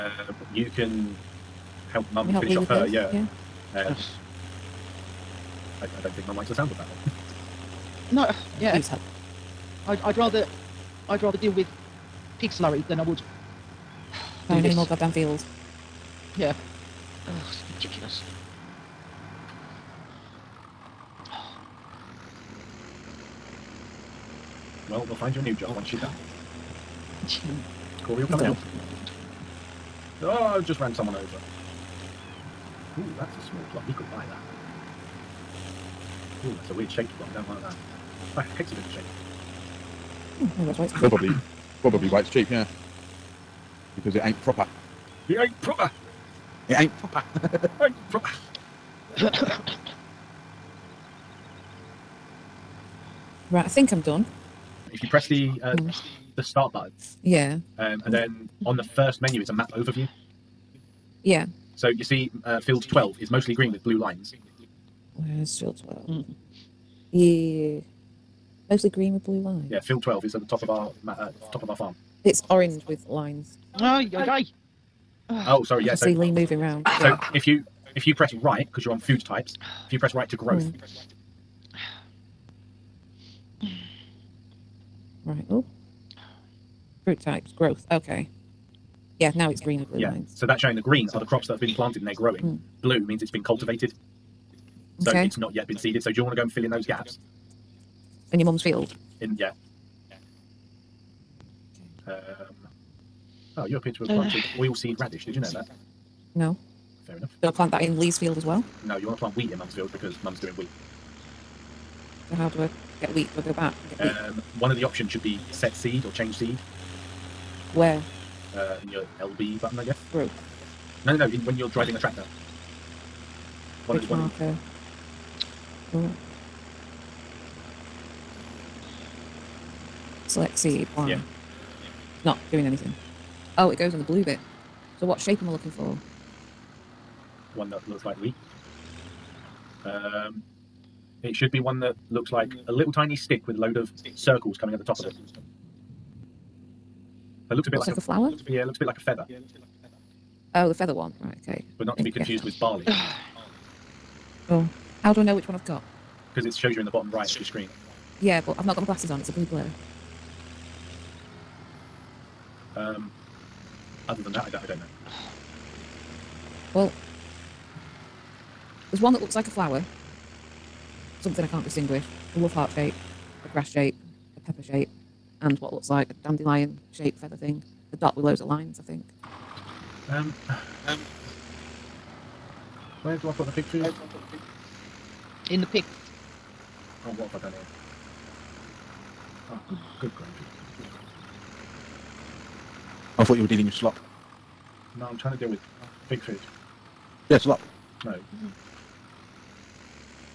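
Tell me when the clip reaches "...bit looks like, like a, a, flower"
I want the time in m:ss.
2:27.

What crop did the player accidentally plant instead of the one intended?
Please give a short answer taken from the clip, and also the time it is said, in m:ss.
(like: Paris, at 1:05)
Oilseed radish, at 1:44.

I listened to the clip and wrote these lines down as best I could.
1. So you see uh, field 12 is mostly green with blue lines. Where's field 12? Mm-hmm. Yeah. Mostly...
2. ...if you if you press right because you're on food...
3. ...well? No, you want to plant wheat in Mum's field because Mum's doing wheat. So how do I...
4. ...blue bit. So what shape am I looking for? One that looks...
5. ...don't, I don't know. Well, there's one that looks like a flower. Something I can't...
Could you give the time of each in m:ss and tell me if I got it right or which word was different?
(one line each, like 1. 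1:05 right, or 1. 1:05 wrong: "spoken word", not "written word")
1. 1:01 right
2. 1:17 right
3. 1:48 right
4. 2:14 right
5. 2:44 right.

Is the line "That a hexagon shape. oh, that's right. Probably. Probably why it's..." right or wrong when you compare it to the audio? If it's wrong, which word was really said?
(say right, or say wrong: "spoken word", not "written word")
right.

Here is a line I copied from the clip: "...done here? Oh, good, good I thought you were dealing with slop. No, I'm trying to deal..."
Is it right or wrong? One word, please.
right.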